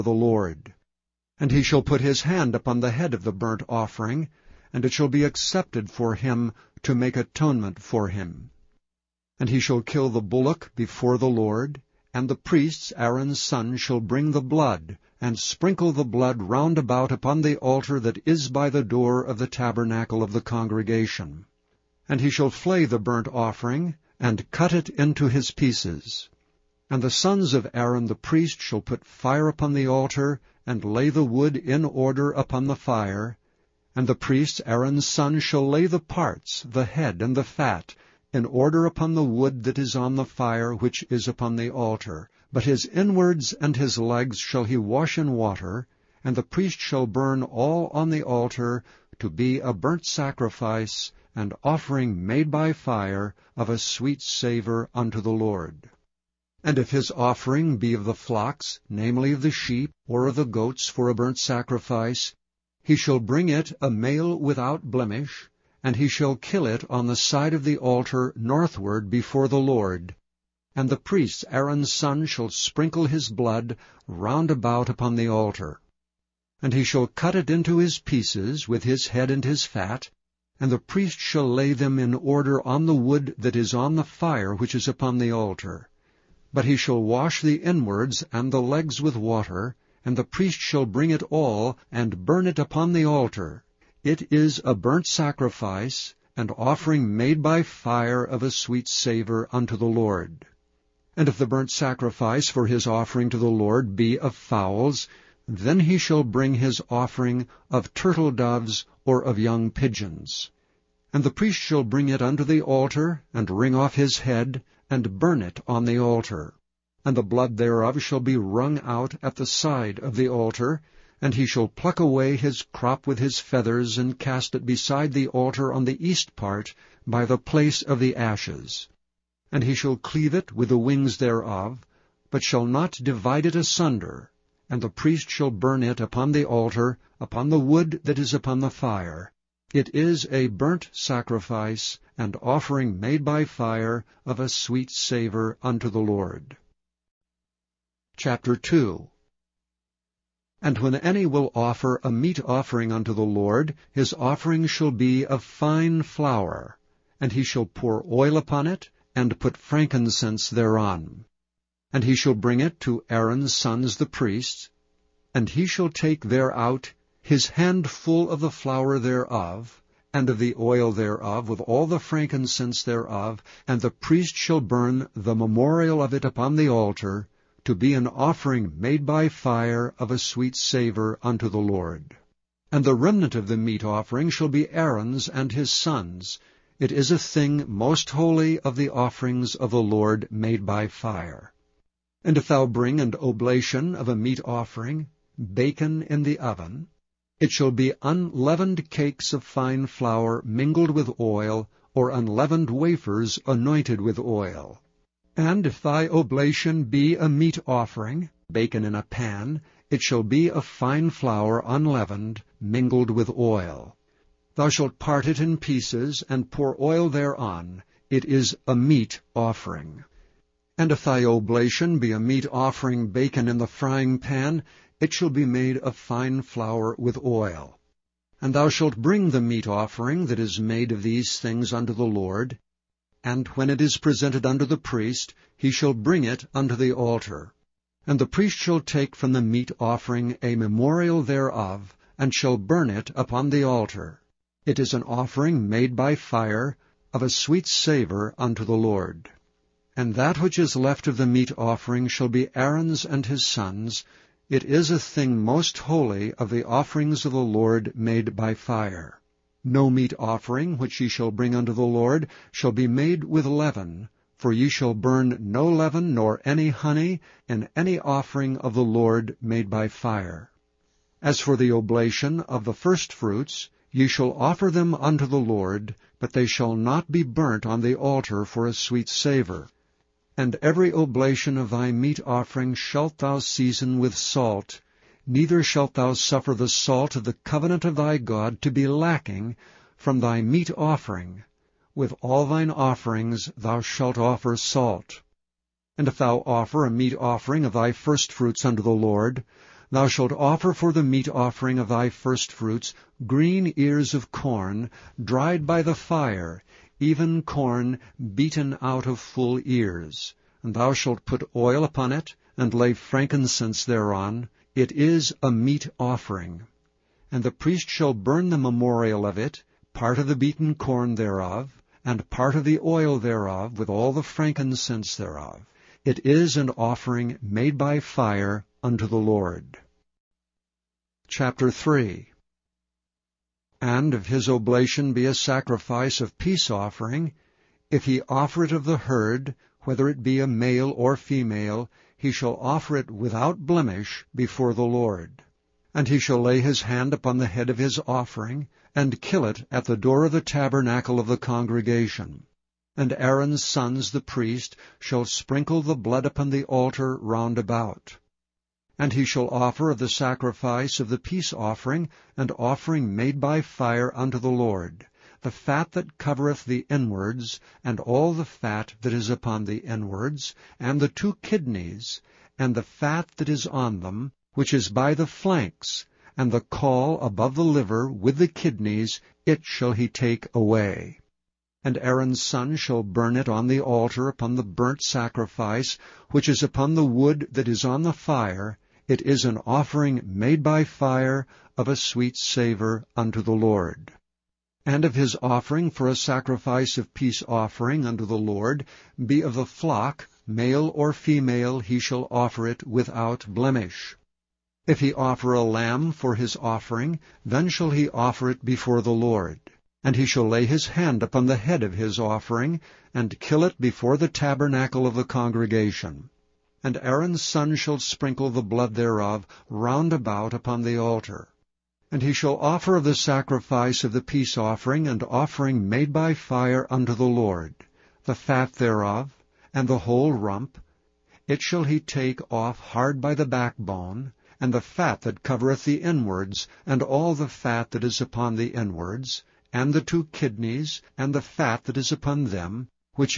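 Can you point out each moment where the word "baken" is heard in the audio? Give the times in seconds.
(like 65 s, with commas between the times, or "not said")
195 s, 208 s, 223 s.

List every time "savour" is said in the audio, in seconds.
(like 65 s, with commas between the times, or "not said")
54 s, 98 s, 144 s, 180 s, 247 s, 279 s, 392 s.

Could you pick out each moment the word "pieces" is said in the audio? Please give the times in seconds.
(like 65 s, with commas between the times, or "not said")
25 s, 77 s, 215 s.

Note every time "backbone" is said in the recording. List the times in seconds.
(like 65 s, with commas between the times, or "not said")
433 s.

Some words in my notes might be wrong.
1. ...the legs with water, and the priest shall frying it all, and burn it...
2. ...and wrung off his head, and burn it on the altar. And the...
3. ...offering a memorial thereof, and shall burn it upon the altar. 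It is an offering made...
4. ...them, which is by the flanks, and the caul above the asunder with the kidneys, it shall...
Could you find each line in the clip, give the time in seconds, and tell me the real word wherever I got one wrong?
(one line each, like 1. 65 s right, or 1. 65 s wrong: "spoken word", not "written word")
1. 88 s wrong: "bring", not "frying"
2. 113 s wrong: "wring", not "wrung"
3. 239 s right
4. 374 s wrong: "liver", not "asunder".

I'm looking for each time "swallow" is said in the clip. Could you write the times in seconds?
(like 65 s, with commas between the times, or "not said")
not said.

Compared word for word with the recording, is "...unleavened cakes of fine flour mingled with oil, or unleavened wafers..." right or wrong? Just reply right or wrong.
right.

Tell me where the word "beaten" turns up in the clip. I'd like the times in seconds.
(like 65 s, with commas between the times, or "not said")
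308 s, 320 s.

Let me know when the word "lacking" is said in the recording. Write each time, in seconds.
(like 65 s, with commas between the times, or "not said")
288 s.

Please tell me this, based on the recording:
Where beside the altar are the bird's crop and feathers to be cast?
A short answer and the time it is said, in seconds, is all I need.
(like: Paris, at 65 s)
On the east part, at 125 s.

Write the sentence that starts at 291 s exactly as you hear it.
With all thine offerings thou shalt offer salt.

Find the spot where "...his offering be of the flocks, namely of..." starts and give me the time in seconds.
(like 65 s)
56 s.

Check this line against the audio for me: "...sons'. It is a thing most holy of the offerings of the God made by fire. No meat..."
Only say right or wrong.
wrong.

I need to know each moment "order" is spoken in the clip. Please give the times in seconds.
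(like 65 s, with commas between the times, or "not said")
31 s, 38 s, 82 s.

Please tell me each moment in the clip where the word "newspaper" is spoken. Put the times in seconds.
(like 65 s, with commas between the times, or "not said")
not said.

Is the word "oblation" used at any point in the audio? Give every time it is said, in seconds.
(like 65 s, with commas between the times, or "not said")
193 s, 206 s, 221 s, 271 s, 280 s, 334 s.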